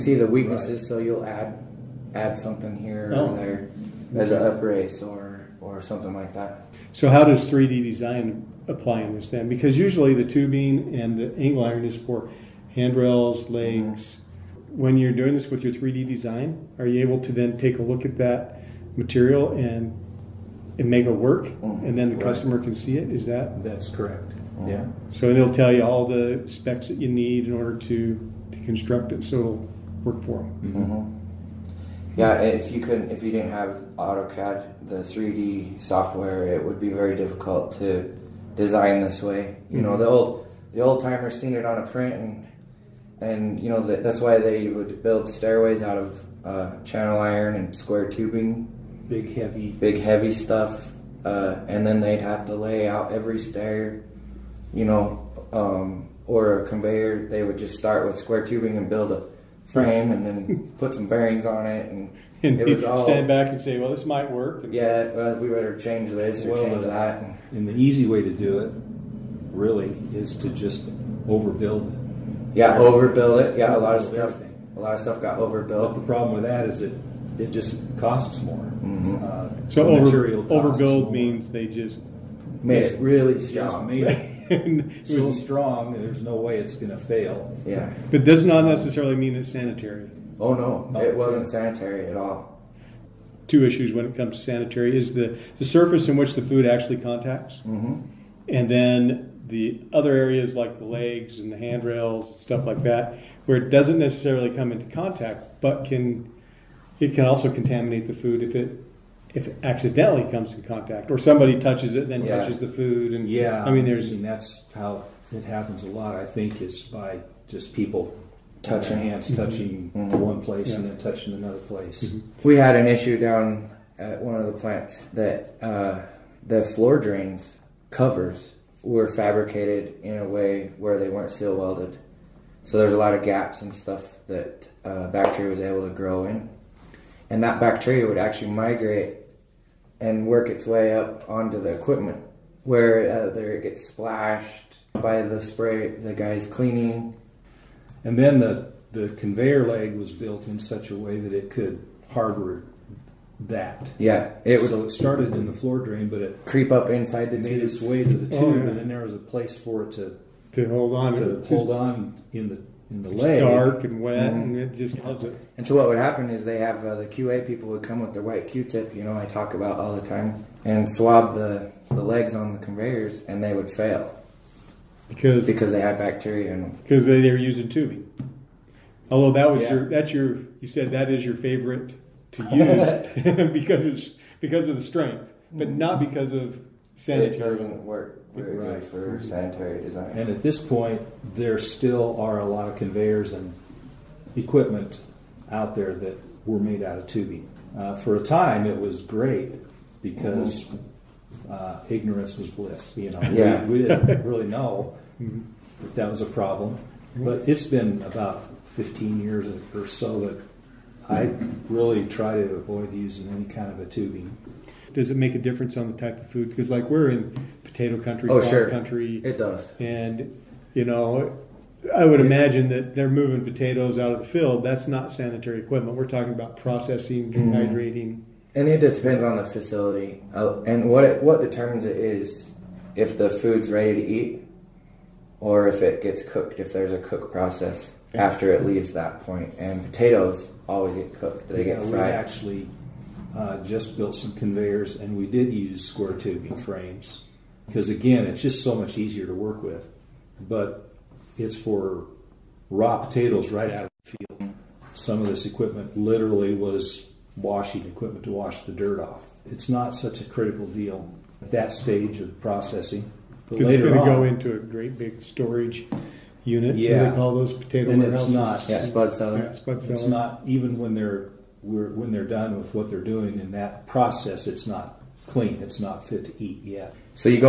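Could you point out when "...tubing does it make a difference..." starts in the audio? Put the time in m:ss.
3:33.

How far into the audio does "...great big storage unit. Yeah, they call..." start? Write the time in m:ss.
4:24.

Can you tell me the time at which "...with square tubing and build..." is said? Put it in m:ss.
0:58.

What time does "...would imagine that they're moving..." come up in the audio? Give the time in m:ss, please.
3:42.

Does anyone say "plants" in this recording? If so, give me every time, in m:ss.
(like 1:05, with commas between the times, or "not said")
2:04.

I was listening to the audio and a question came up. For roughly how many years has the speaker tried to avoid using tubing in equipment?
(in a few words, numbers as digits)
15 years.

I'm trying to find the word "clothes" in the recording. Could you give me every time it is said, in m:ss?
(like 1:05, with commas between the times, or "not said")
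not said.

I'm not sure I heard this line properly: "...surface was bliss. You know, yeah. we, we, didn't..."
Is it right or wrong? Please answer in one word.
wrong.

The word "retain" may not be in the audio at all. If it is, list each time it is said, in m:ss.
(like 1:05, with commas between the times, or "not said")
not said.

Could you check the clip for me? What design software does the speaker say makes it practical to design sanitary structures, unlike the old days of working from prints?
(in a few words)
AutoCAD.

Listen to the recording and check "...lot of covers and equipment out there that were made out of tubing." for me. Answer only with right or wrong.
wrong.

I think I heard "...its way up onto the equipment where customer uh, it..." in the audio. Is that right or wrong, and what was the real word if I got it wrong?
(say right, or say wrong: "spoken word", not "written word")
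wrong: "either", not "customer".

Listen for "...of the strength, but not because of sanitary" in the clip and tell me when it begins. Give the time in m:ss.
3:04.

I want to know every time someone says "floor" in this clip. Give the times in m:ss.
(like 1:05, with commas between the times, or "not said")
2:06, 2:35.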